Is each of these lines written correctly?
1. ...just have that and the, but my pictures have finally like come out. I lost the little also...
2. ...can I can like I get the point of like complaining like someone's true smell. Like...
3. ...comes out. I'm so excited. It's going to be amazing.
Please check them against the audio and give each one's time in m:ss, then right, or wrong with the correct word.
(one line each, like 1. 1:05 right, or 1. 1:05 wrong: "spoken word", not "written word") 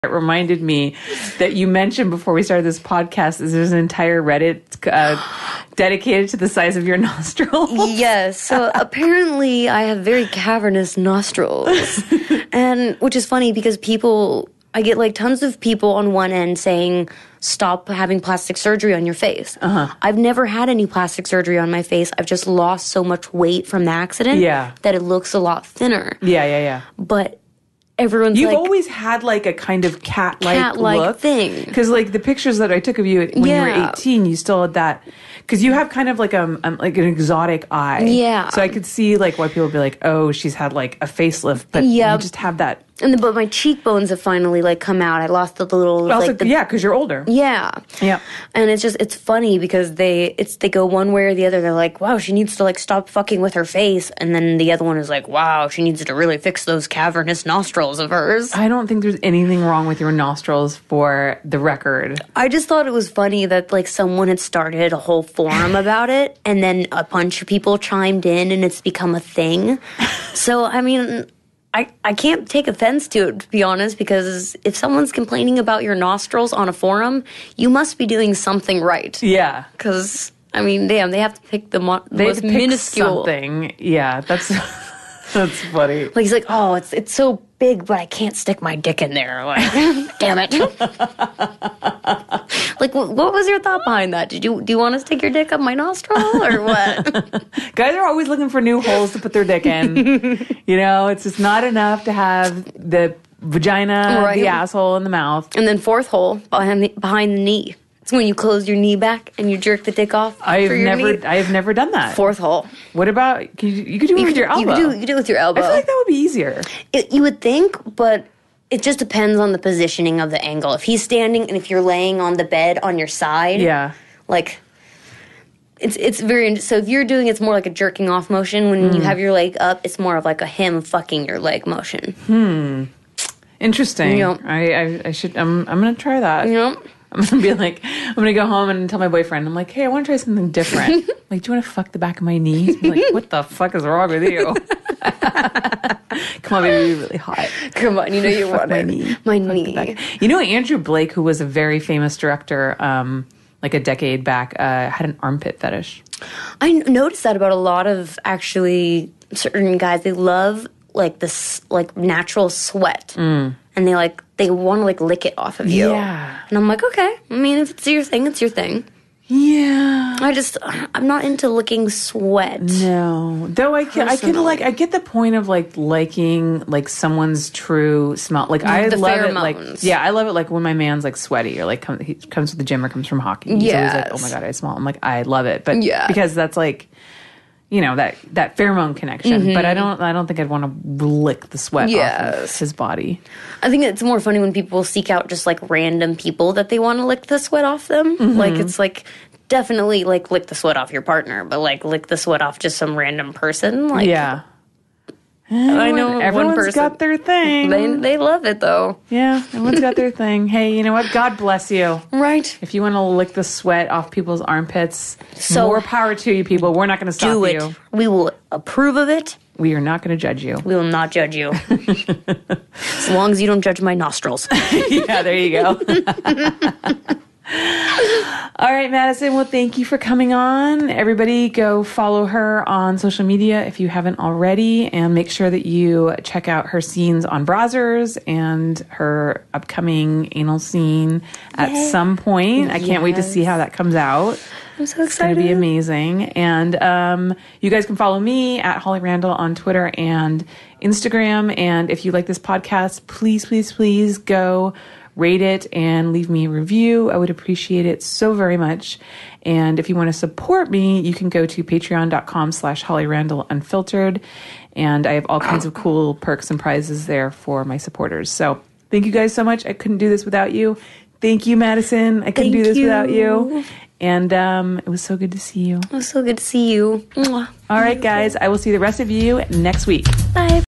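1. 0:42 wrong: "cheekbones", not "pictures"
2. 2:53 wrong: "liking", not "complaining"
3. 4:03 right.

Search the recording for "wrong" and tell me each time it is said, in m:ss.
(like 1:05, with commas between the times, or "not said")
0:59, 2:23.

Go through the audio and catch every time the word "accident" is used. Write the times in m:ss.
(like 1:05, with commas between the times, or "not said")
0:23.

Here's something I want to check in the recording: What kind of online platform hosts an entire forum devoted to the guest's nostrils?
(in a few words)
Reddit.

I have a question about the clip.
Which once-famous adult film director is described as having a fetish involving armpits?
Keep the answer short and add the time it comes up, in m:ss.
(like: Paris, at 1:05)
Andrew Blake, at 2:30.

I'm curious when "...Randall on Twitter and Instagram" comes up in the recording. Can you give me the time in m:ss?
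4:09.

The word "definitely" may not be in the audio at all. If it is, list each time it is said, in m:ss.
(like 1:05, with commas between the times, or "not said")
3:19.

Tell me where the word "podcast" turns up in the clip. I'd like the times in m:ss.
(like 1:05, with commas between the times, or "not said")
0:02, 4:12.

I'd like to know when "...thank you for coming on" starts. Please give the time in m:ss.
3:49.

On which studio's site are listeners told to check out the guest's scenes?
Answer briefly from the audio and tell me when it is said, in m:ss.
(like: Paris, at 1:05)
Brazzers, at 3:57.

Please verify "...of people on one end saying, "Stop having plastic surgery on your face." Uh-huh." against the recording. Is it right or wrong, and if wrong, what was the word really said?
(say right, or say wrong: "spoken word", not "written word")
right.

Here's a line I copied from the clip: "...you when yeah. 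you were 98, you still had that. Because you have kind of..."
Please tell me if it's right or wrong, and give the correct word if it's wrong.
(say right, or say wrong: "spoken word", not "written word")
wrong: "18", not "98".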